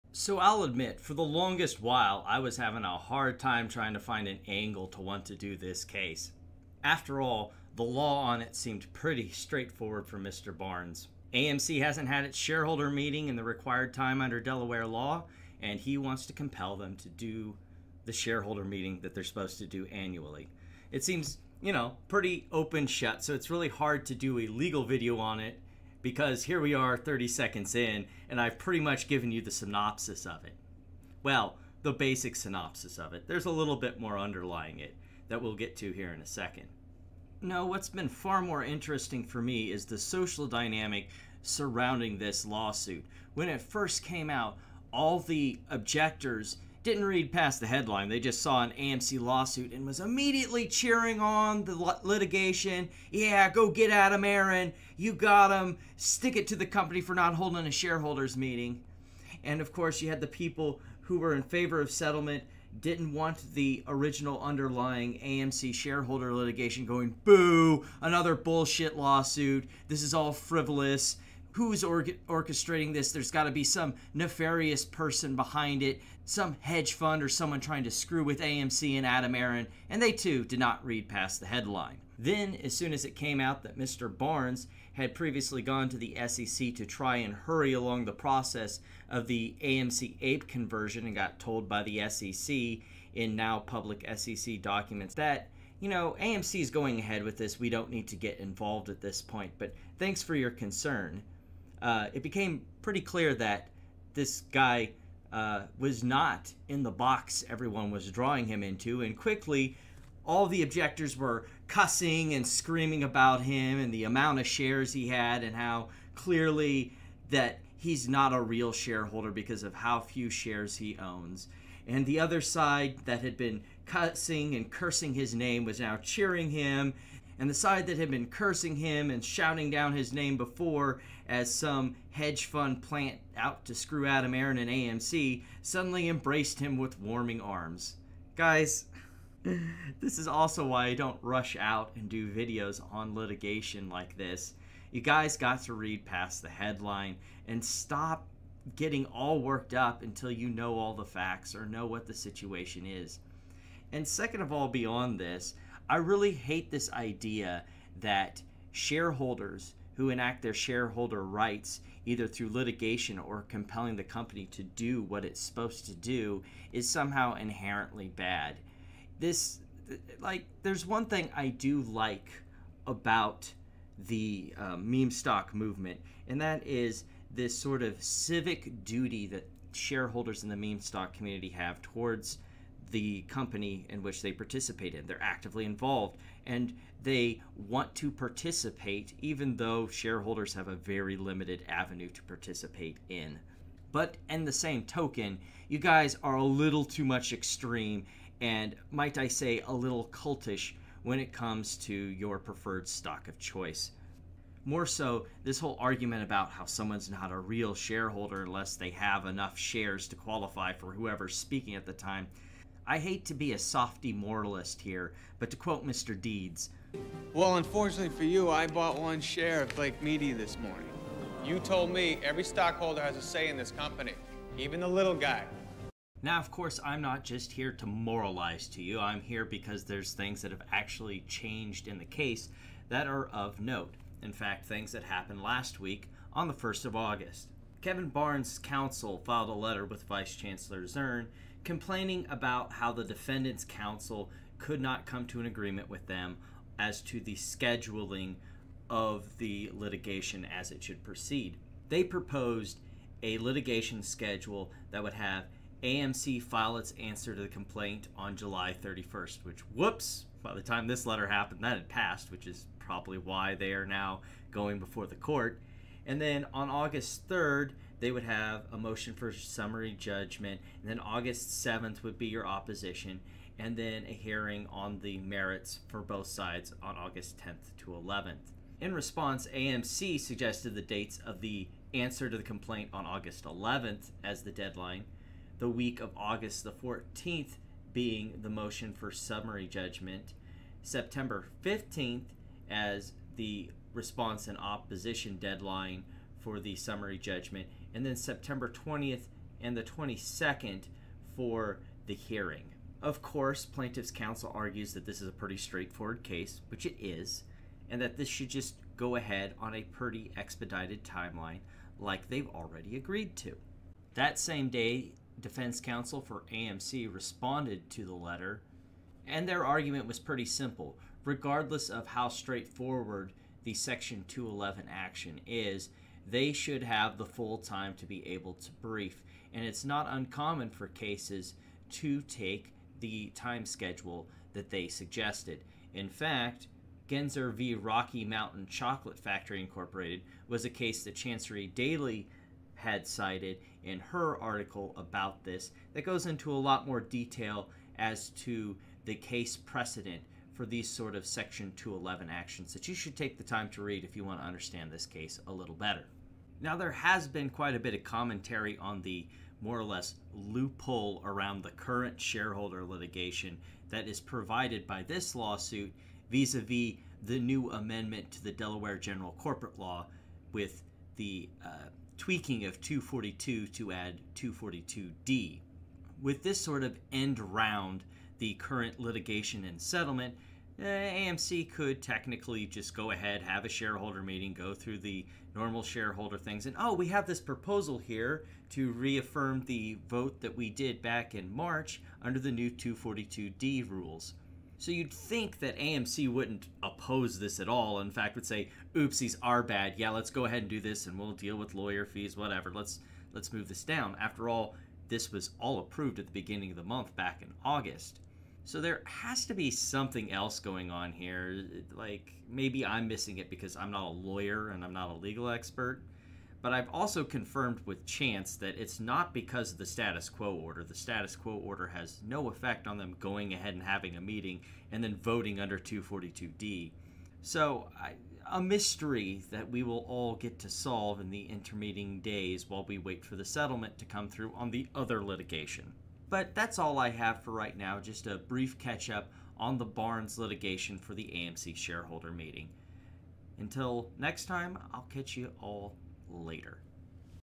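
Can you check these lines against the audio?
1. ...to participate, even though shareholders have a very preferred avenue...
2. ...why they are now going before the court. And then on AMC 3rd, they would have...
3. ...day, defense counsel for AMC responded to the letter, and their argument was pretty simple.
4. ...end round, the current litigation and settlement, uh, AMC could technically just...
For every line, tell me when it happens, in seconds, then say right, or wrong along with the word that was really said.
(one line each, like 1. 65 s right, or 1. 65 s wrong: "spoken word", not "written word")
1. 187 s wrong: "limited", not "preferred"
2. 263 s wrong: "August", not "AMC"
3. 314 s right
4. 377 s right.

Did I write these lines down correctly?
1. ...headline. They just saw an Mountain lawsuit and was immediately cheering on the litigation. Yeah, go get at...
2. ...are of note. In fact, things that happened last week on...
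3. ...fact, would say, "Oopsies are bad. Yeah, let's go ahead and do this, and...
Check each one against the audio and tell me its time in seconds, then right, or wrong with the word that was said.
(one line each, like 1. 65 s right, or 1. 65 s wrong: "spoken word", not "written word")
1. 47 s wrong: "AMC", not "Mountain"
2. 233 s right
3. 398 s right.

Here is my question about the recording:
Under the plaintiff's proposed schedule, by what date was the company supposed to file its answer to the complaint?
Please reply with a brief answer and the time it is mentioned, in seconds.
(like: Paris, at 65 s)
July 31st, at 258 s.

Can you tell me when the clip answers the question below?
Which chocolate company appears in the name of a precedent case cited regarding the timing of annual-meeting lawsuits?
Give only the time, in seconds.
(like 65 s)
337 s.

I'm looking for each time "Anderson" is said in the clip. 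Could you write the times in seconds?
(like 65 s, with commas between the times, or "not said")
not said.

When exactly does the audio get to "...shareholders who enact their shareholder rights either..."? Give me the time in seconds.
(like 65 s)
158 s.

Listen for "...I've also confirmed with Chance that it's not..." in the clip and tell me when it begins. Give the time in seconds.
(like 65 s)
416 s.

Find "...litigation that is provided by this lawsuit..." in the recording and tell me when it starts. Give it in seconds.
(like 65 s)
362 s.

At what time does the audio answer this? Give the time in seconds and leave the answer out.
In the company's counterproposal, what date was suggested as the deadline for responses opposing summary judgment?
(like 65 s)
290 s.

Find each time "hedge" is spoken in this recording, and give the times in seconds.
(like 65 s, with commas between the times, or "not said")
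76 s, 132 s.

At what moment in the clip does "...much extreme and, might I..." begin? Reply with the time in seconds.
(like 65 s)
197 s.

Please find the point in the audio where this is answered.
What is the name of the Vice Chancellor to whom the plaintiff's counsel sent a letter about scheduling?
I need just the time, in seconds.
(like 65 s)
240 s.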